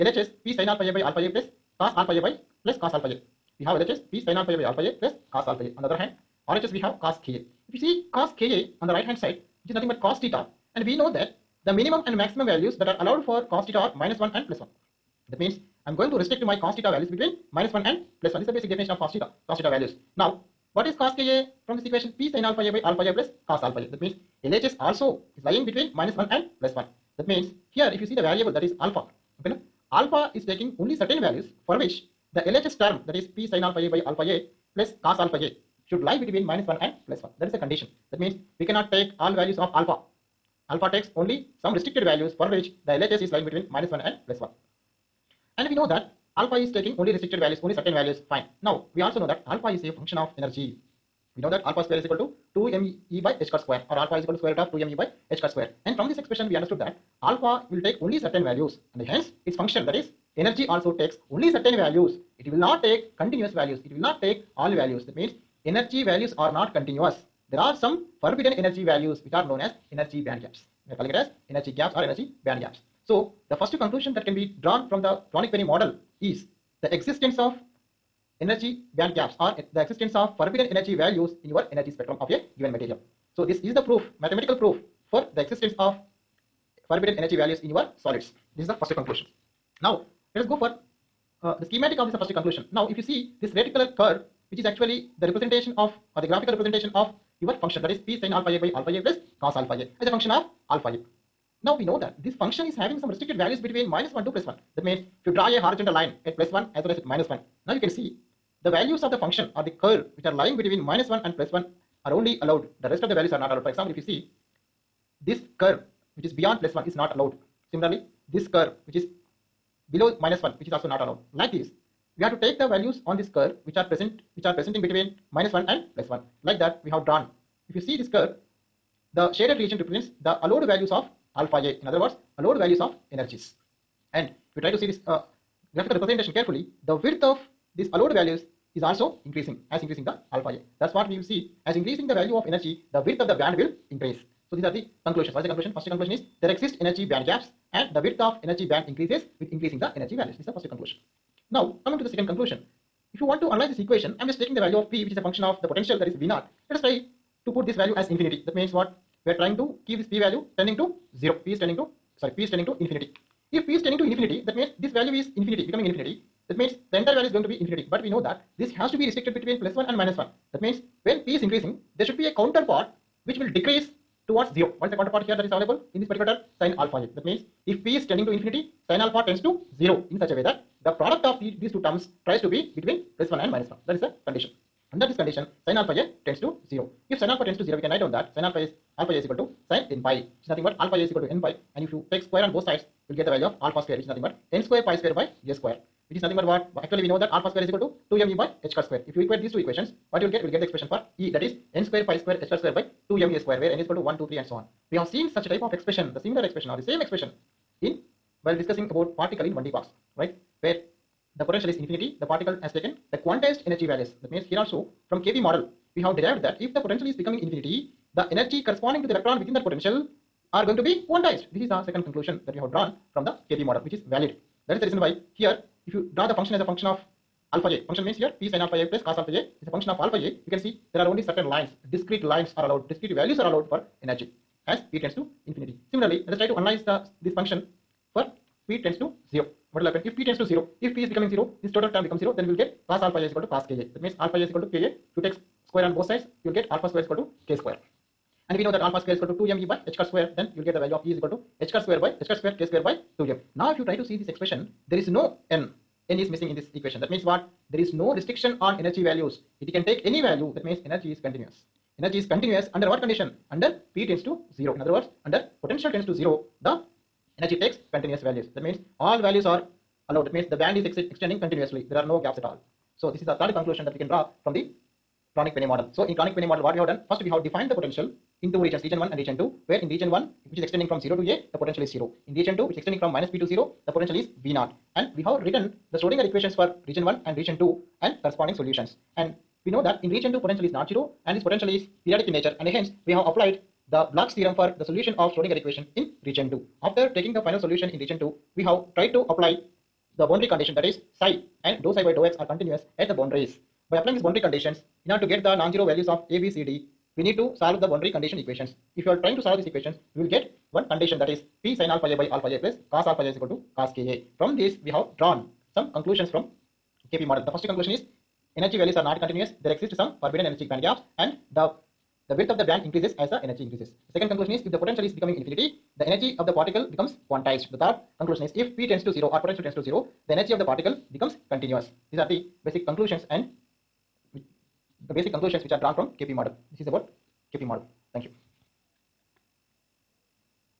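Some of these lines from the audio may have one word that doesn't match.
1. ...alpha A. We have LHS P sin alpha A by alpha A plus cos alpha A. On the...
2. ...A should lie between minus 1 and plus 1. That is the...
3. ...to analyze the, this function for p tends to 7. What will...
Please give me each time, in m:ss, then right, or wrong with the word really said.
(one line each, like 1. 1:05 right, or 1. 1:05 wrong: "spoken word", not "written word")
1. 0:02 right
2. 0:35 right
3. 3:56 wrong: "0", not "7".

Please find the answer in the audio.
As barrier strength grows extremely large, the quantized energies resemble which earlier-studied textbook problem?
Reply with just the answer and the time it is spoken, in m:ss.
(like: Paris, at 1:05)
Particle in 1D box, at 3:29.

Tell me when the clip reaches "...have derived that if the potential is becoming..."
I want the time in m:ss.
3:36.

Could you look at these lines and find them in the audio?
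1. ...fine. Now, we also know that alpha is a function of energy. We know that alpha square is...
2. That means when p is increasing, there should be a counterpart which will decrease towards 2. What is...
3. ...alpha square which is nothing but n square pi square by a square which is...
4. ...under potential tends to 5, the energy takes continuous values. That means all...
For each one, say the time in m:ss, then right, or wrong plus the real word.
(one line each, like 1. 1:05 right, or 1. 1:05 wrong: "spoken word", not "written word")
1. 0:48 right
2. 2:50 wrong: "0", not "2"
3. 3:13 right
4. 4:25 wrong: "0", not "5".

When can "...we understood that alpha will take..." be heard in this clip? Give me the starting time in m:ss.
0:56.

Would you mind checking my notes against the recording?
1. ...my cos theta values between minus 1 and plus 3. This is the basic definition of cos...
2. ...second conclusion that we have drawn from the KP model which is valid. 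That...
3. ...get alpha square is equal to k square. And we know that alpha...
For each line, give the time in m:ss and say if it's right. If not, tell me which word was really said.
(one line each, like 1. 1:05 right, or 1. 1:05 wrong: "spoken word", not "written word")
1. 0:16 wrong: "1", not "3"
2. 3:41 right
3. 4:06 right.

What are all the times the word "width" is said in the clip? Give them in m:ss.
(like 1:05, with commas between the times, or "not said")
2:16, 2:23, 2:28, 5:22.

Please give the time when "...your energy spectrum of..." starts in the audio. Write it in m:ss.
1:21.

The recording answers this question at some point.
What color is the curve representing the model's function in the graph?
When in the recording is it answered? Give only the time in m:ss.
1:33.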